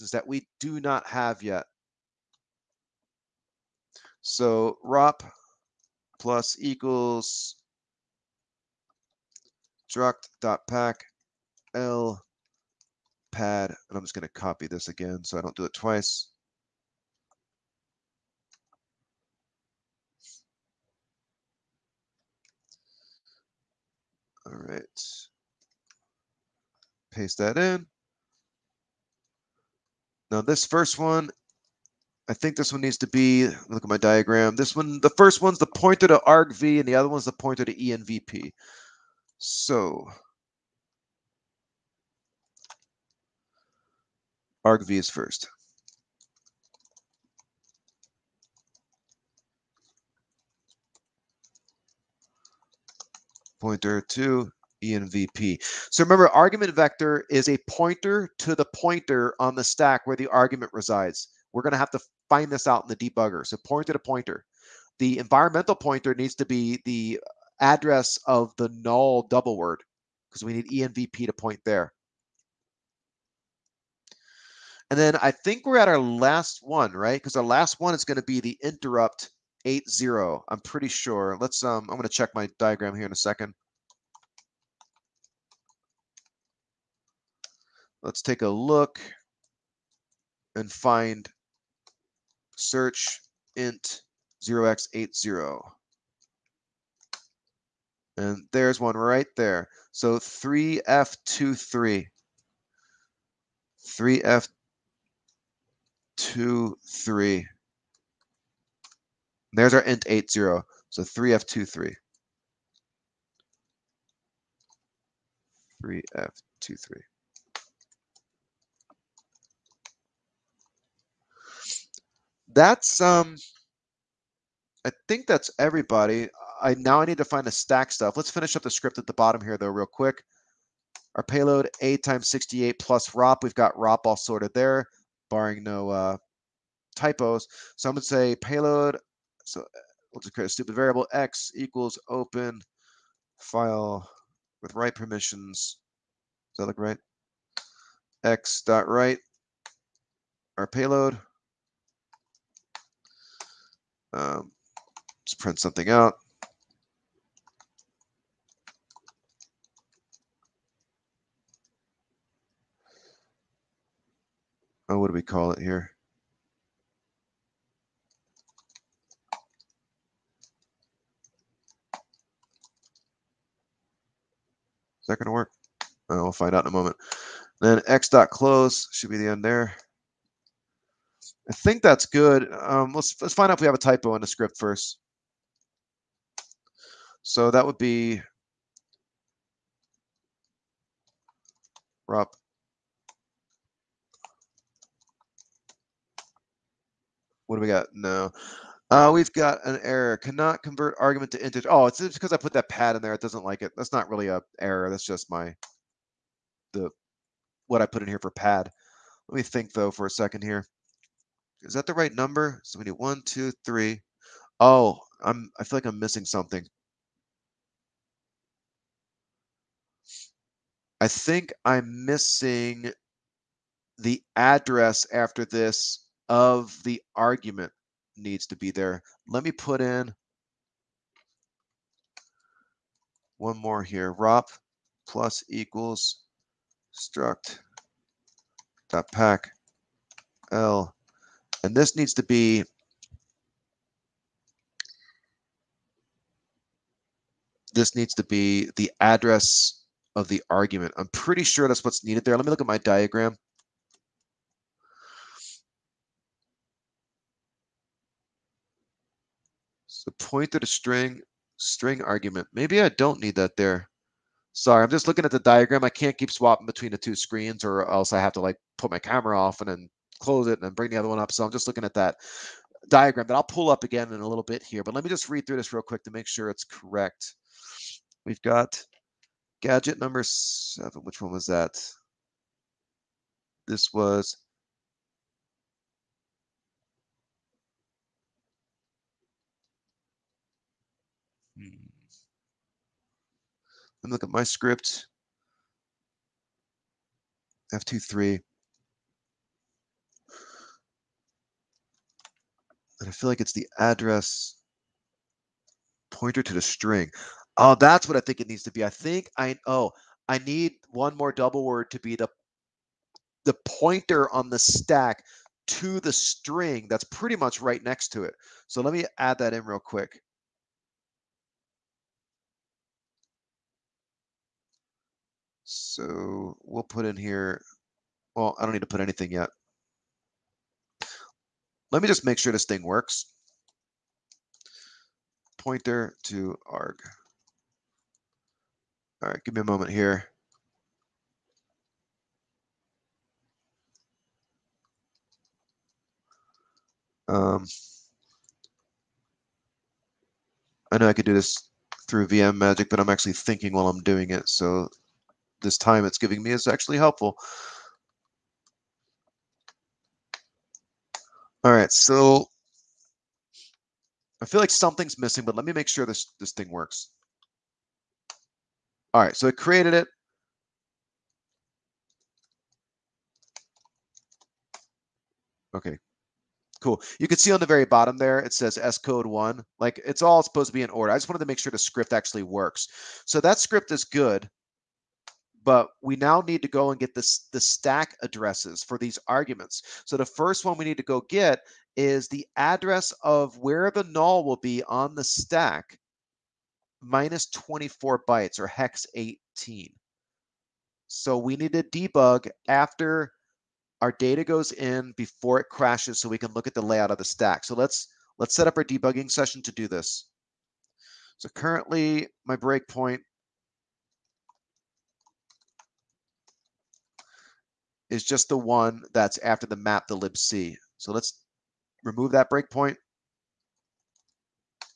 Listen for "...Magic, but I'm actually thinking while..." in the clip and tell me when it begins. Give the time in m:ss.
5:52.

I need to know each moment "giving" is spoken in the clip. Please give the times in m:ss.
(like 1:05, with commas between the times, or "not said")
5:56.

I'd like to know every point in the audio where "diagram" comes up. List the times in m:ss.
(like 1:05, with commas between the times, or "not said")
0:33, 1:22, 4:12, 4:25, 4:32.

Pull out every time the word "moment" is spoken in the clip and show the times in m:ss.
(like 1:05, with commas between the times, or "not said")
2:56, 5:39.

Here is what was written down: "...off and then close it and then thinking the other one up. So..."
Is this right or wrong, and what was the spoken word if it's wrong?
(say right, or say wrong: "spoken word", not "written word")
wrong: "bring", not "thinking".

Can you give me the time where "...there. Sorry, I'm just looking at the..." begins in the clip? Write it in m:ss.
4:23.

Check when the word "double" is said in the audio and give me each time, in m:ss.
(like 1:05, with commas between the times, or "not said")
1:09, 5:11.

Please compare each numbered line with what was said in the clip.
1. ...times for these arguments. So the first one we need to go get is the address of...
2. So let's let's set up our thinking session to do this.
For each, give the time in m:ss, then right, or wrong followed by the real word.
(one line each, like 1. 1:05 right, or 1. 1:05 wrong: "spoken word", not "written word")
1. 6:28 wrong: "addresses", not "times"
2. 6:47 wrong: "debugging", not "thinking".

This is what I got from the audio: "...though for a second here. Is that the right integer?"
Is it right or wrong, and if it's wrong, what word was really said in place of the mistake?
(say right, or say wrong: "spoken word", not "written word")
wrong: "number", not "integer".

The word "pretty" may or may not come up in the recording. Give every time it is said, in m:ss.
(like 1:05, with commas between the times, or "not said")
1:20, 4:11, 5:17.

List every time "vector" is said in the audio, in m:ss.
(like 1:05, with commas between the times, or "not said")
0:56.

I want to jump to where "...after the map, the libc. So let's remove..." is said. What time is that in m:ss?
6:59.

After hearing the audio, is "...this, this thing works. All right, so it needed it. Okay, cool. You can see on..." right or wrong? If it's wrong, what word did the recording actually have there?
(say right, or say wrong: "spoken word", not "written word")
wrong: "created", not "needed".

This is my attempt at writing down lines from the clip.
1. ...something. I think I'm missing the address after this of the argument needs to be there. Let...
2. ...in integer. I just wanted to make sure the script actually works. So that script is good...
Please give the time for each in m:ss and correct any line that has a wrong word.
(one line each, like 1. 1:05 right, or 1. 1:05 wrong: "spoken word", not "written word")
1. 3:36 right
2. 6:20 wrong: "order", not "integer".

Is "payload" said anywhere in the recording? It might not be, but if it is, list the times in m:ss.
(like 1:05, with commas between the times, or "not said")
2:11, 2:18, 2:30.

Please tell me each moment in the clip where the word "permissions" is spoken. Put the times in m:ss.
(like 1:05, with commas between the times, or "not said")
2:24.